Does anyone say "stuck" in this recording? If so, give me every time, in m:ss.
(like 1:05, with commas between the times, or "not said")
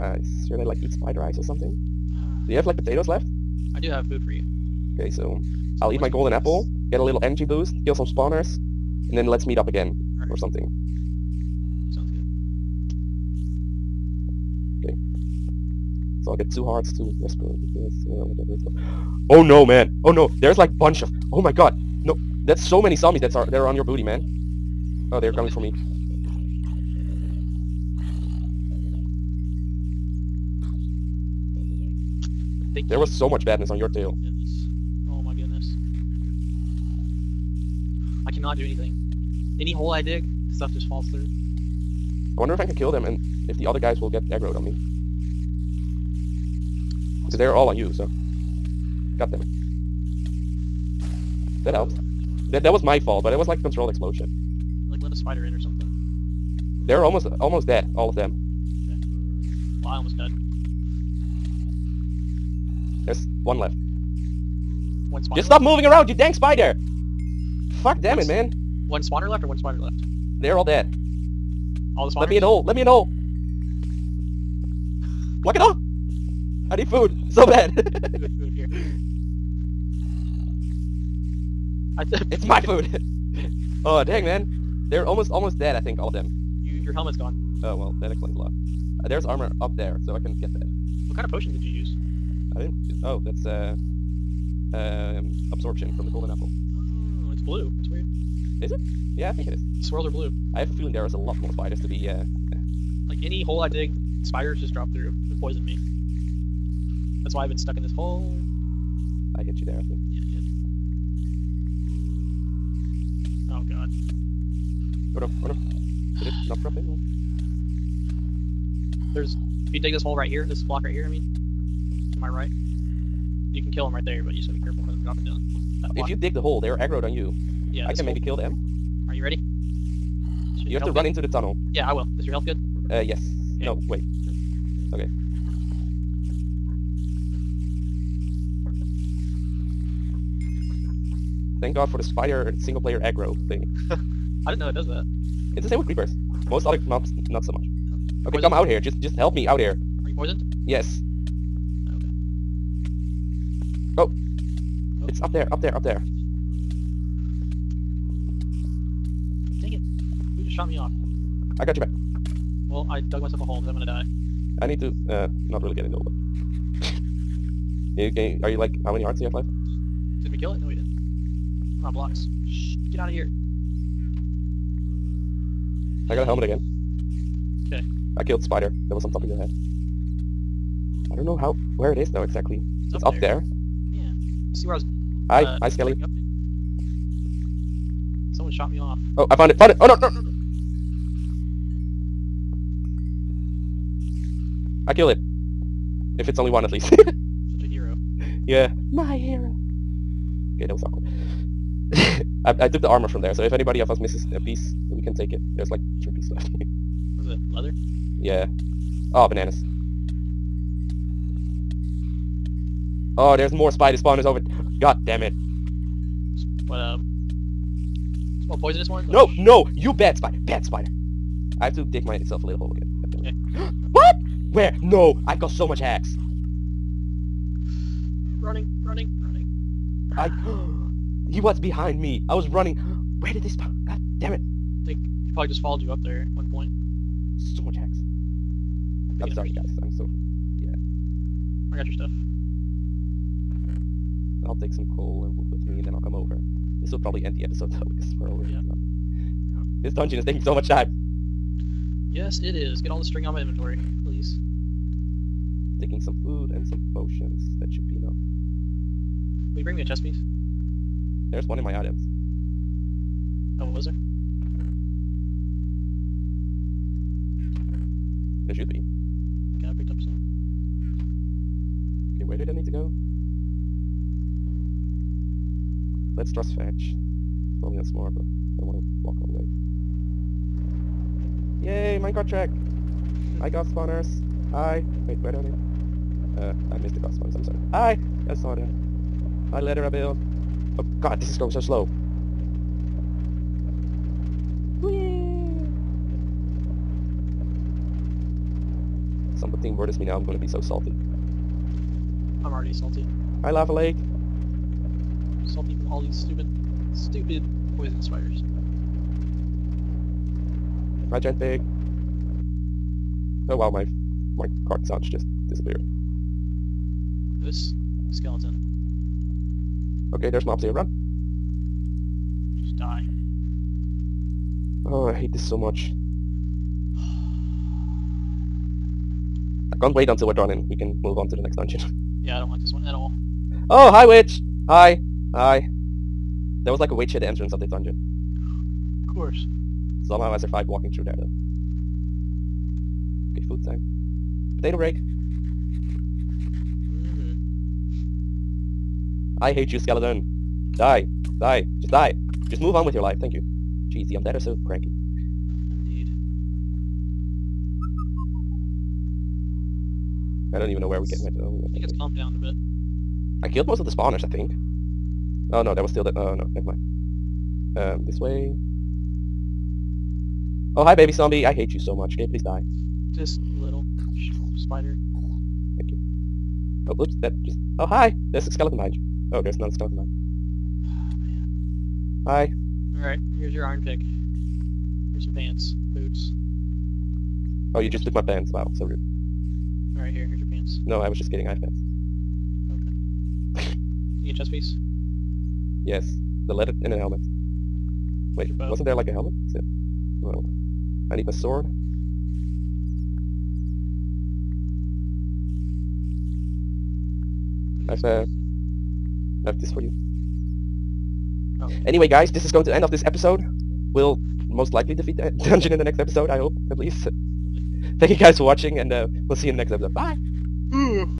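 1:47.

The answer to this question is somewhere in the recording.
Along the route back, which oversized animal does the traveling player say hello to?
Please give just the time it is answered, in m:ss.
5:11.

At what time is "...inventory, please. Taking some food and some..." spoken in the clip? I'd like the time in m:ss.
4:13.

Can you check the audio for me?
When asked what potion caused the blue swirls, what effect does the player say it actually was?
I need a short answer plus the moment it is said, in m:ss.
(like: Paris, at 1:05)
absorption, at 1:35.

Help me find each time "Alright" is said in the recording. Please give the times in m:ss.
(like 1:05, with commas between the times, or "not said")
6:23, 6:29.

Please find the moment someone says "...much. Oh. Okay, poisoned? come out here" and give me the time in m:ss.
2:27.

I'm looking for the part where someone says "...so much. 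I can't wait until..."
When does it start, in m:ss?
5:25.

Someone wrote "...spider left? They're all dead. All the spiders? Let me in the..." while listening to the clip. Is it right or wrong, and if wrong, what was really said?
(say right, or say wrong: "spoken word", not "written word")
wrong: "spawners", not "spiders".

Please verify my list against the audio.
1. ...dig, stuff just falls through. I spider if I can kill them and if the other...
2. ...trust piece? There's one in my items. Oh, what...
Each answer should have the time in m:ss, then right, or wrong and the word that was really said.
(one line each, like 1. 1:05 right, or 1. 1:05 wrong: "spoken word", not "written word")
1. 0:40 wrong: "wonder", not "spider"
2. 4:19 wrong: "chest", not "trust".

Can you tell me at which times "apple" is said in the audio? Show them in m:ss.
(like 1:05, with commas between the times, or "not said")
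0:06, 1:36.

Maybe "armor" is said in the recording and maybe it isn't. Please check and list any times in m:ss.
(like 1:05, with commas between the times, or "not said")
1:29, 3:22.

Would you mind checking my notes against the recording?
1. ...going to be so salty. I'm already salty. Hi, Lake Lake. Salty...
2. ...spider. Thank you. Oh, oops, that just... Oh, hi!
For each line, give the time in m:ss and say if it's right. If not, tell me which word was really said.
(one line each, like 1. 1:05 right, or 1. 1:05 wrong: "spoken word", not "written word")
1. 5:00 wrong: "Lava", not "Lake"
2. 6:14 right.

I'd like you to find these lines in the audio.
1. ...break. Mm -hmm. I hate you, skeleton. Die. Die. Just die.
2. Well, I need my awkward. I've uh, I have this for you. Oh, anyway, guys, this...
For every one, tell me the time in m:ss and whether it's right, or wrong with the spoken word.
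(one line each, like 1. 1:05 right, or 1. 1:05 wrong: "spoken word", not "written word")
1. 5:44 right
2. 6:40 wrong: "sword", not "awkward".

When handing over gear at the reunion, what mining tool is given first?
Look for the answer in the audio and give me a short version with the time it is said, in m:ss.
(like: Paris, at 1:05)
iron pick, at 6:23.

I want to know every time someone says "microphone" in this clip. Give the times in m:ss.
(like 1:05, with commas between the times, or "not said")
not said.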